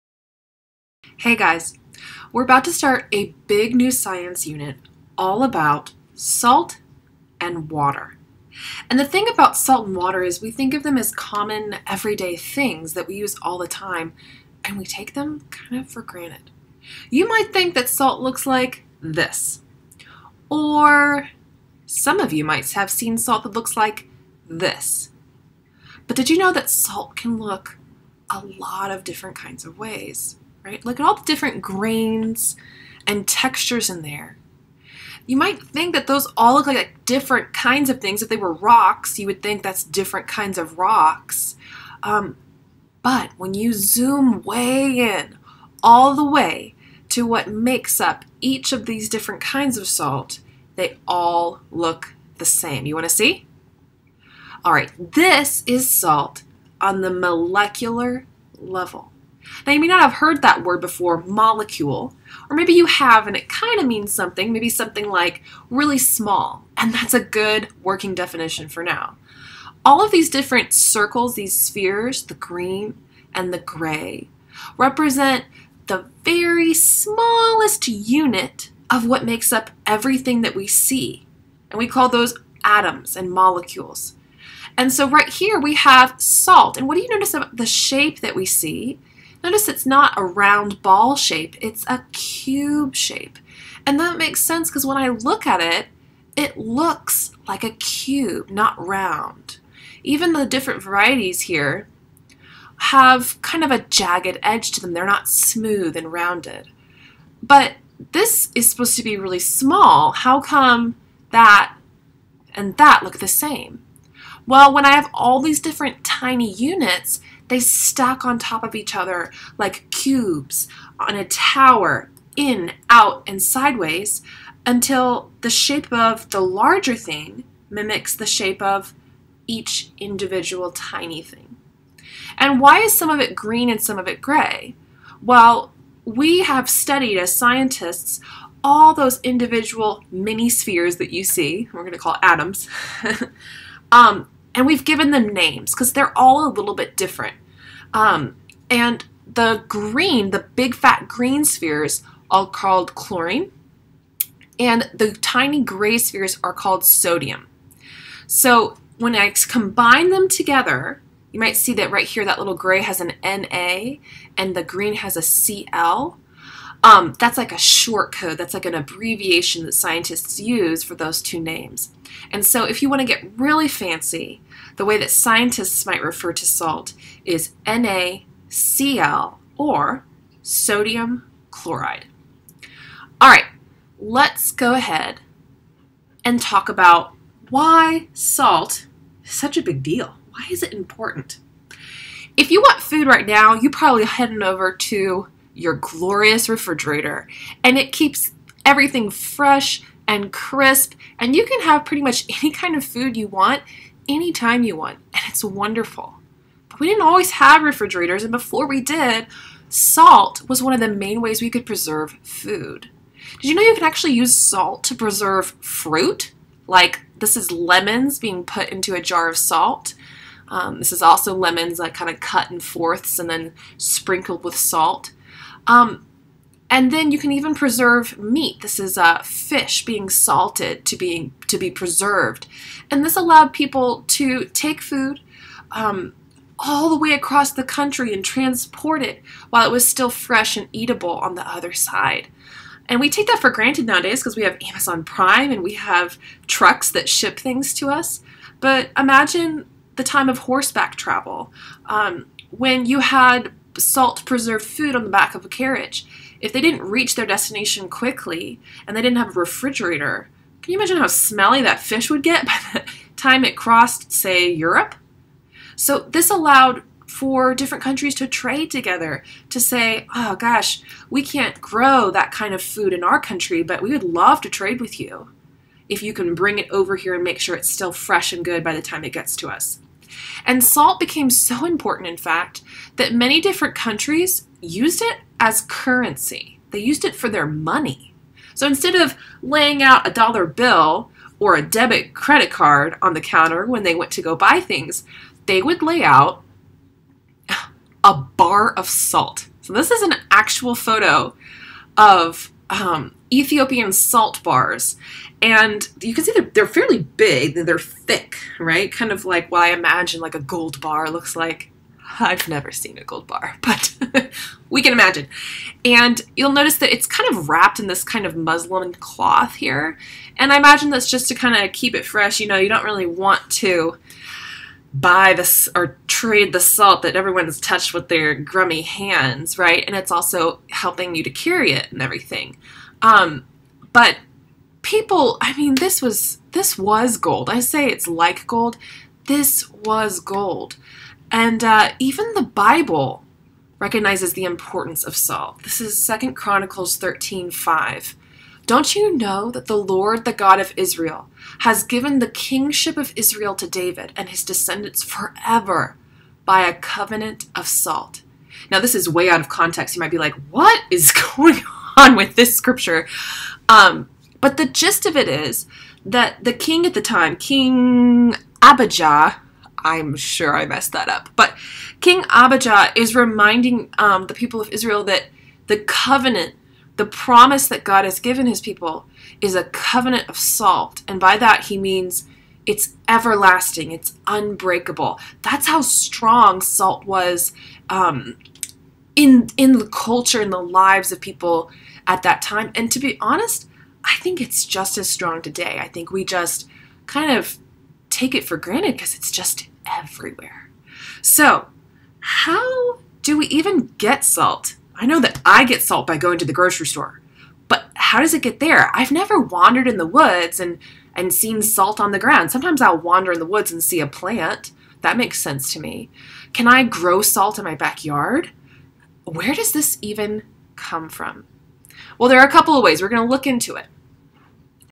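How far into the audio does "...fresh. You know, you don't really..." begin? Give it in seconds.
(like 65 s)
322 s.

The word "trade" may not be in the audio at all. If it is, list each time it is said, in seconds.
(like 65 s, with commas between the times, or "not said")
268 s, 274 s, 326 s.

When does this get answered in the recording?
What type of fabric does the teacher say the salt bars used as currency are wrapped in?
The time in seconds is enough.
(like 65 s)
318 s.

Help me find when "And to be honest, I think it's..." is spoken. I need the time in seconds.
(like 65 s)
392 s.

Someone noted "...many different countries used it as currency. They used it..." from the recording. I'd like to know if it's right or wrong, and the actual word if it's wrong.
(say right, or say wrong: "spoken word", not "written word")
right.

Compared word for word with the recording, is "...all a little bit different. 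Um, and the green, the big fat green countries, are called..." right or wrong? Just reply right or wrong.
wrong.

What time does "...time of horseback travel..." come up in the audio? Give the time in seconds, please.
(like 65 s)
250 s.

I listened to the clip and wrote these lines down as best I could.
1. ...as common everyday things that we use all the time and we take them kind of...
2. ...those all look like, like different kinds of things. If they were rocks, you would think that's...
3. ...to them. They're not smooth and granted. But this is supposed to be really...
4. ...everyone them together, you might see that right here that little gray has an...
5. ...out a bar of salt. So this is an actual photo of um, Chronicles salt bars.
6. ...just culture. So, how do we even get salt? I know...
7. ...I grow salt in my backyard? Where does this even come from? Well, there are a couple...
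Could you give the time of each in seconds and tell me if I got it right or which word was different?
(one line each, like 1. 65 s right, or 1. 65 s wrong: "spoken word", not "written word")
1. 10 s right
2. 36 s right
3. 104 s wrong: "rounded", not "granted"
4. 159 s wrong: "combine", not "everyone"
5. 296 s wrong: "Ethiopian", not "Chronicles"
6. 399 s wrong: "everywhere", not "culture"
7. 416 s right.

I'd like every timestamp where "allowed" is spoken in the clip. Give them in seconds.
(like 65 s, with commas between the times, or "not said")
233 s, 266 s.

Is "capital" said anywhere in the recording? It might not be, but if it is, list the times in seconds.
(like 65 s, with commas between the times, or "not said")
not said.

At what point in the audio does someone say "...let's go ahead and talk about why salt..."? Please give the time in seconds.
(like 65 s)
183 s.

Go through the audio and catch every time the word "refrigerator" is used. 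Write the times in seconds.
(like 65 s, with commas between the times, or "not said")
196 s, 207 s, 259 s.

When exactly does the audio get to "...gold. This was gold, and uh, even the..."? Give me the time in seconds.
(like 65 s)
338 s.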